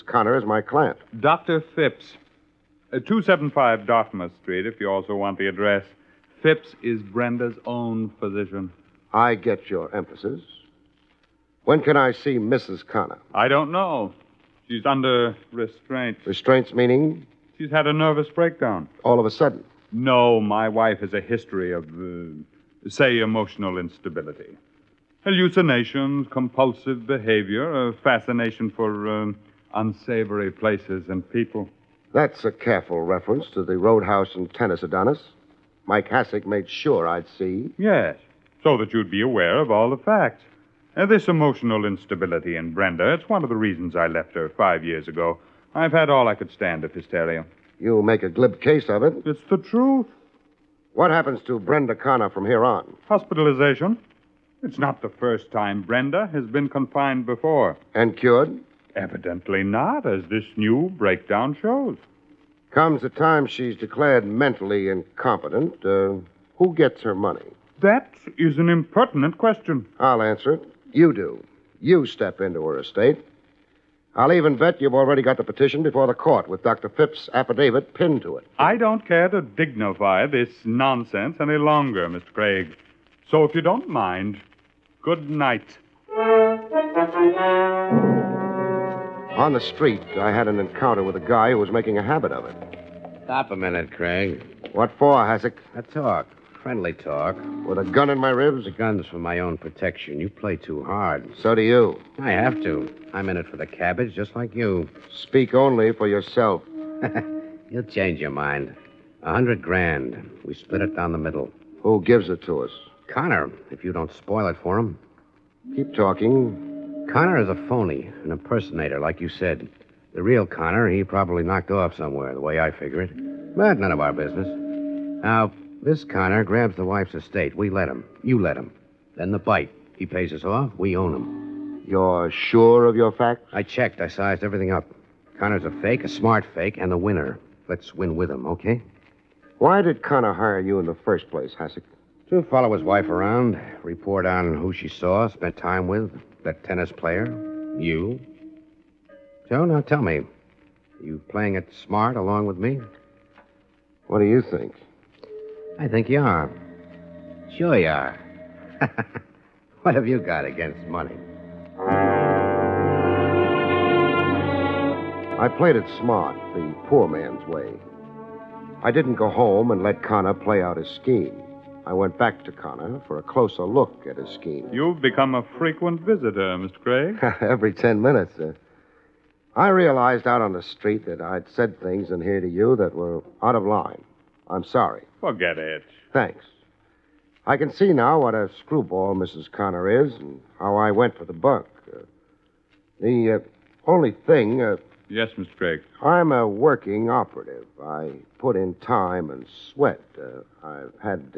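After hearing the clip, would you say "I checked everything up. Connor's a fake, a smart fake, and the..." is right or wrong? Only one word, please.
wrong.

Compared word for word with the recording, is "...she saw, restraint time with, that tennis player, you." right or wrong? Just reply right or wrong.
wrong.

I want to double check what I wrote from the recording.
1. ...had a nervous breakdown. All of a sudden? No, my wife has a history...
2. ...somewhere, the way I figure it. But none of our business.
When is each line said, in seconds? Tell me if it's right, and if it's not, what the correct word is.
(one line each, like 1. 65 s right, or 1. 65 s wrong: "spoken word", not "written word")
1. 17 s right
2. 121 s right.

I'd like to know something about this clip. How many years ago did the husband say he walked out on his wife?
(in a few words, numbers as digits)
5.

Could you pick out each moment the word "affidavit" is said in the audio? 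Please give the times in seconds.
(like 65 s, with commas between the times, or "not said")
77 s.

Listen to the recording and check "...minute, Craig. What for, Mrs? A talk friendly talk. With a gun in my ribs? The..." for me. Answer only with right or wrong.
wrong.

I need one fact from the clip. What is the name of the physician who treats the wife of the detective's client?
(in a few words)
Dr. Phipps.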